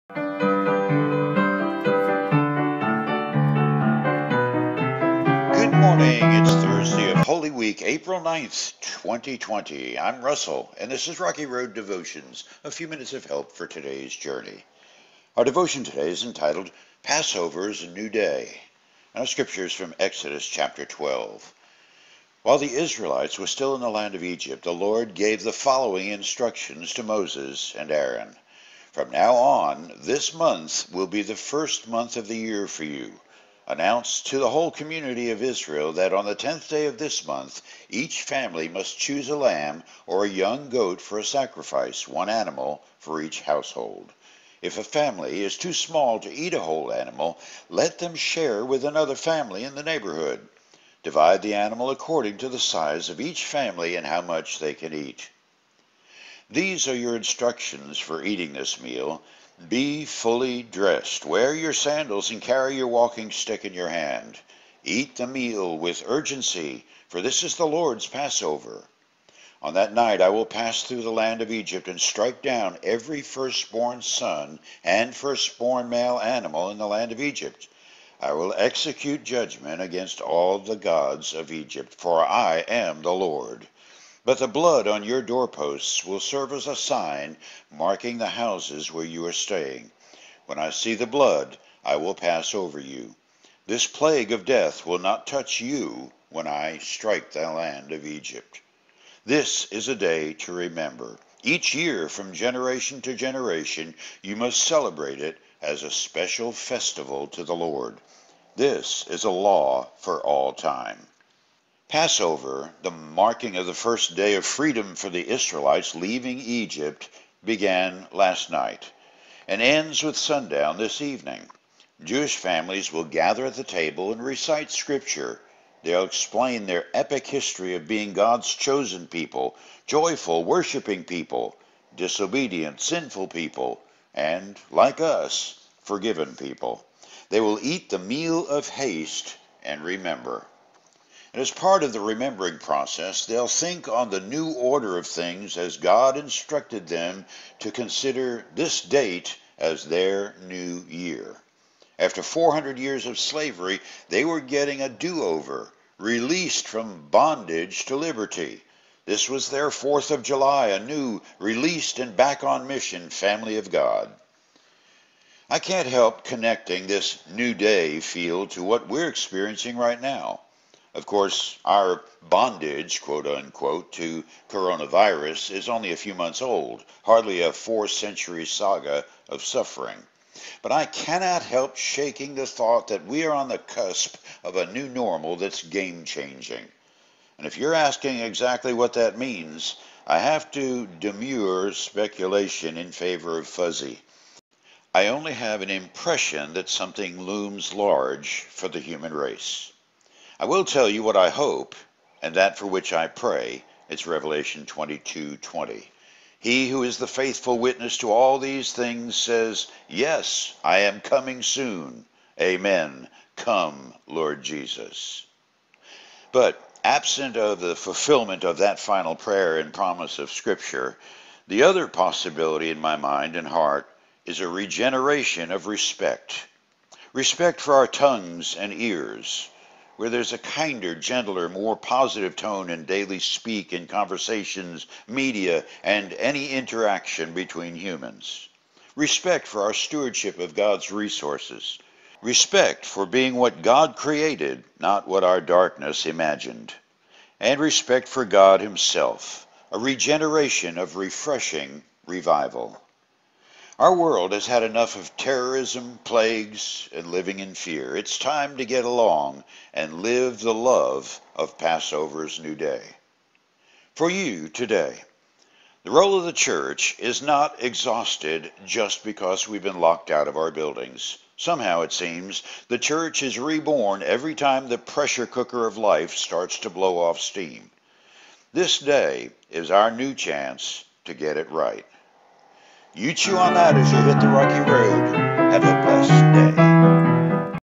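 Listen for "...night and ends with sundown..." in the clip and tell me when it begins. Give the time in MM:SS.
01:58.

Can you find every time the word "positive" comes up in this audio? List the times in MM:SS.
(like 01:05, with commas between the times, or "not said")
03:51.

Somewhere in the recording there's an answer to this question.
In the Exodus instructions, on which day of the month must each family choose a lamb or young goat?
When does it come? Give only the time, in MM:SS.
00:36.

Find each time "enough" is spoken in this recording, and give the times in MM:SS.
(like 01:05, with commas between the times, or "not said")
04:14.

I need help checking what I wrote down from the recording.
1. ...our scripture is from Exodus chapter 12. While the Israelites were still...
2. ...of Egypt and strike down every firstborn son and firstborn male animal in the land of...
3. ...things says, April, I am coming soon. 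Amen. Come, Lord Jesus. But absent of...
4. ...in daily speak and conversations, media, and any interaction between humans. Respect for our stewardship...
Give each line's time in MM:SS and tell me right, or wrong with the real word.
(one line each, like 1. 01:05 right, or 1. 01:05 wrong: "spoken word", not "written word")
1. 00:19 right
2. 01:11 right
3. 03:28 wrong: "Yes", not "April"
4. 03:52 right.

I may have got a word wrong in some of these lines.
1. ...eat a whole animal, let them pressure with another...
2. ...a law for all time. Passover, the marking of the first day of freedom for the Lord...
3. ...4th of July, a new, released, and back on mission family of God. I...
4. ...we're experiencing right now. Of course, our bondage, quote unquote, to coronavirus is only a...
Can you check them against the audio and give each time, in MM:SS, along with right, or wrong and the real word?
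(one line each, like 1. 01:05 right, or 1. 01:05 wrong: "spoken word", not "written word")
1. 00:46 wrong: "share", not "pressure"
2. 01:49 wrong: "Israelites", not "Lord"
3. 02:39 right
4. 02:48 right.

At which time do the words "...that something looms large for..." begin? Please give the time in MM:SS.
03:16.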